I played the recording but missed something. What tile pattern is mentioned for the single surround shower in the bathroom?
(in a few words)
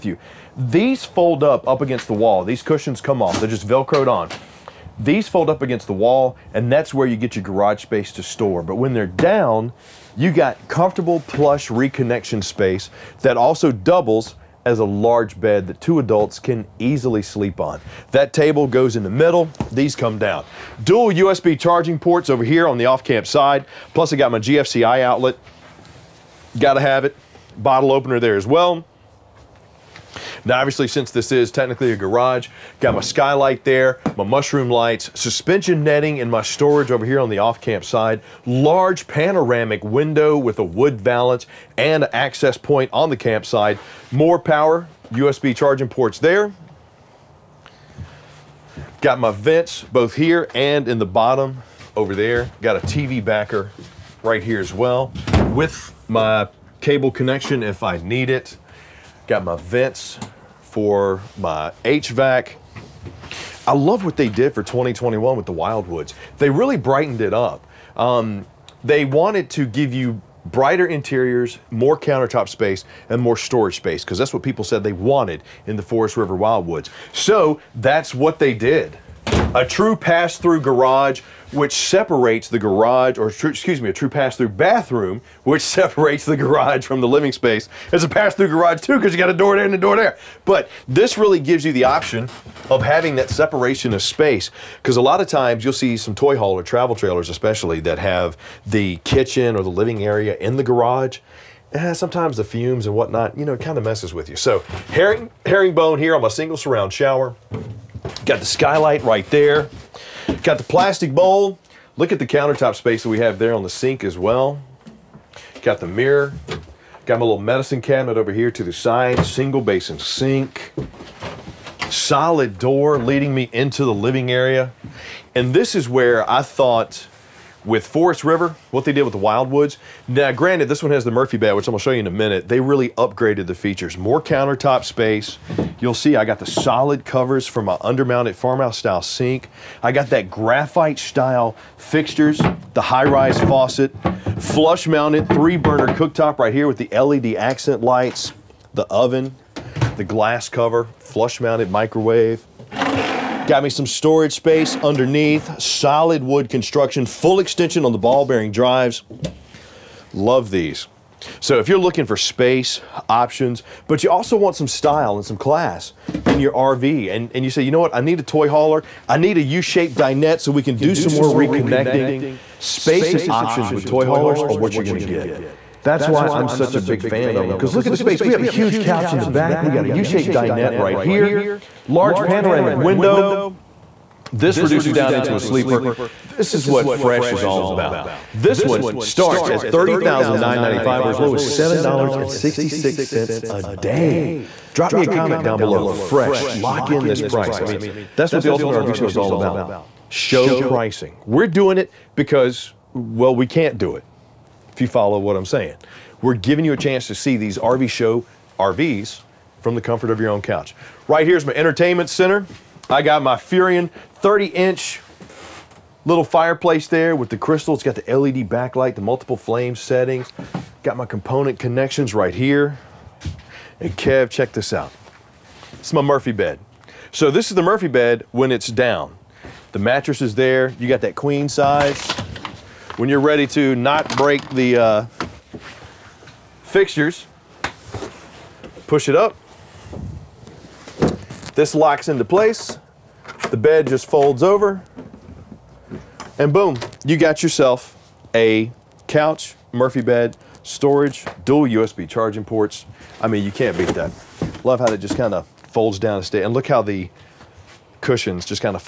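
Herringbone.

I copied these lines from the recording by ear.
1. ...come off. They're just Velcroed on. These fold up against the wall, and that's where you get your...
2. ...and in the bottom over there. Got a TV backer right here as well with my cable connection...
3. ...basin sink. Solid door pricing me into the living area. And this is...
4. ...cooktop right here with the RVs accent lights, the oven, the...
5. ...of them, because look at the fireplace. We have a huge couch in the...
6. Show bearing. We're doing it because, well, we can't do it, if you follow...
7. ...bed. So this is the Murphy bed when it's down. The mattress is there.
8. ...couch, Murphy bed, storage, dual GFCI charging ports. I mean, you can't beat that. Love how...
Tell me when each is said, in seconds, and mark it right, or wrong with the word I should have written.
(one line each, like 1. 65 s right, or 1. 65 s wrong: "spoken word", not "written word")
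1. 3 s right
2. 50 s right
3. 119 s wrong: "leading", not "pricing"
4. 145 s wrong: "LED", not "RVs"
5. 177 s wrong: "space", not "fireplace"
6. 200 s wrong: "pricing", not "bearing"
7. 226 s right
8. 249 s wrong: "USB", not "GFCI".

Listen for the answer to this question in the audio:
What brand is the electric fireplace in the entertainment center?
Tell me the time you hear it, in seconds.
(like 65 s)
213 s.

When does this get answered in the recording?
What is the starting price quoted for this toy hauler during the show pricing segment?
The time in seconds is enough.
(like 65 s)
189 s.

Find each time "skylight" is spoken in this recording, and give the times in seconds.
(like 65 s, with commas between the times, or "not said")
33 s, 108 s.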